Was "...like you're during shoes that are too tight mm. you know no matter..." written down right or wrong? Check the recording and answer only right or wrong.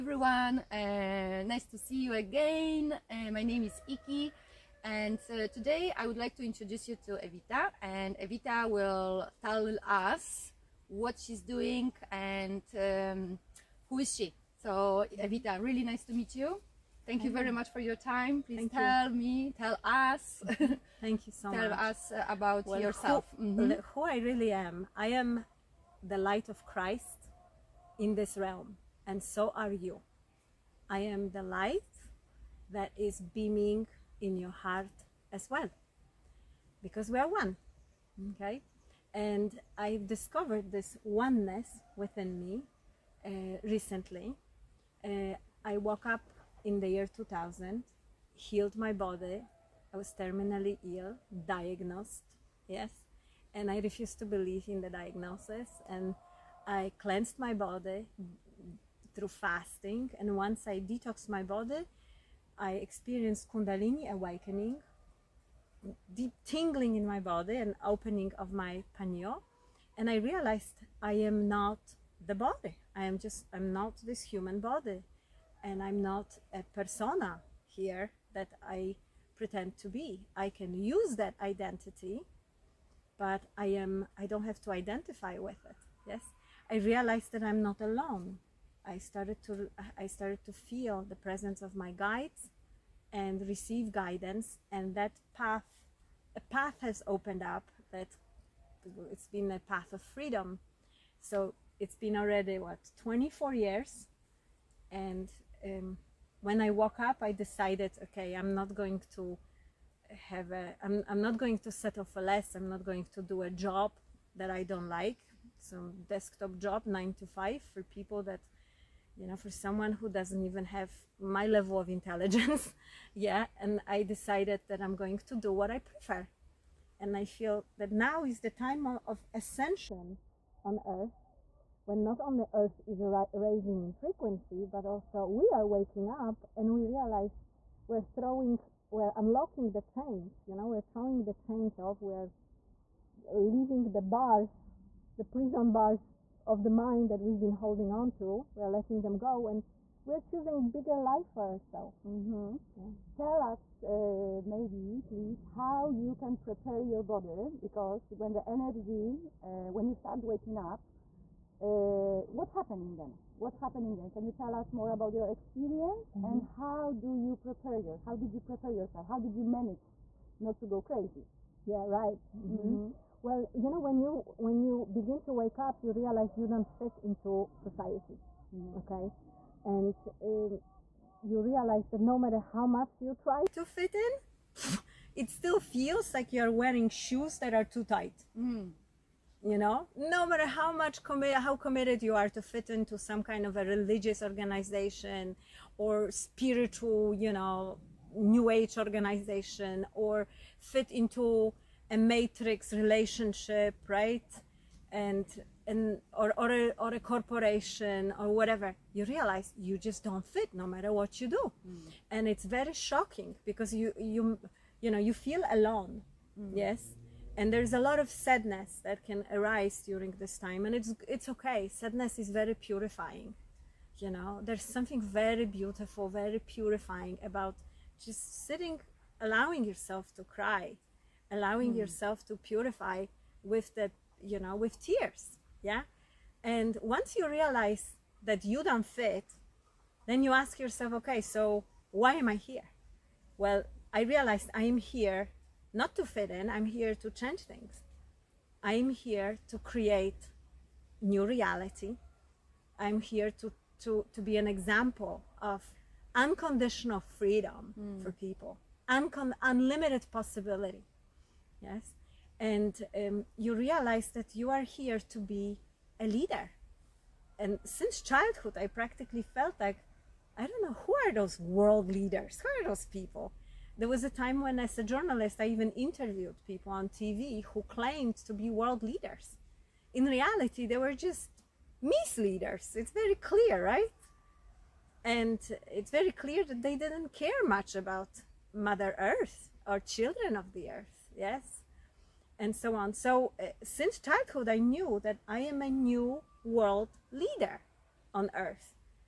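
wrong.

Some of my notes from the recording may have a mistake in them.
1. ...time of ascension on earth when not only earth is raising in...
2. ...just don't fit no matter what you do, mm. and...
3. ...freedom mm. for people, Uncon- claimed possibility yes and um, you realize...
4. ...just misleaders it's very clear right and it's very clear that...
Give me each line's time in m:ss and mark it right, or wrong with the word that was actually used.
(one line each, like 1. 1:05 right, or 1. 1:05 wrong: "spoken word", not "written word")
1. 2:08 right
2. 3:29 right
3. 4:17 wrong: "unlimited", not "claimed"
4. 4:41 right.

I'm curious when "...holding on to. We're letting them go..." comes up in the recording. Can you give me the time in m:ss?
2:27.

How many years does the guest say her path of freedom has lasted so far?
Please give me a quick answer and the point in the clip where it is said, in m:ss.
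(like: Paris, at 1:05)
24 years, at 1:43.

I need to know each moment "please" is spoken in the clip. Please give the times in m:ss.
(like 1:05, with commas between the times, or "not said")
0:18, 2:35.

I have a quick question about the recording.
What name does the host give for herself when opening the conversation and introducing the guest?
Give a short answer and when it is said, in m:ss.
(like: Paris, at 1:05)
Iki, at 0:03.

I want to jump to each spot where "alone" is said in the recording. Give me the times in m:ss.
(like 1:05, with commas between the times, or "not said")
1:27, 3:35.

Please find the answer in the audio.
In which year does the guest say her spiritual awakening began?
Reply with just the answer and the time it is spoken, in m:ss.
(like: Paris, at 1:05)
2000, at 0:47.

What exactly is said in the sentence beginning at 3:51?
yourself to purify with that, you know, with tears.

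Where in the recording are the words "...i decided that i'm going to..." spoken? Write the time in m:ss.
2:03.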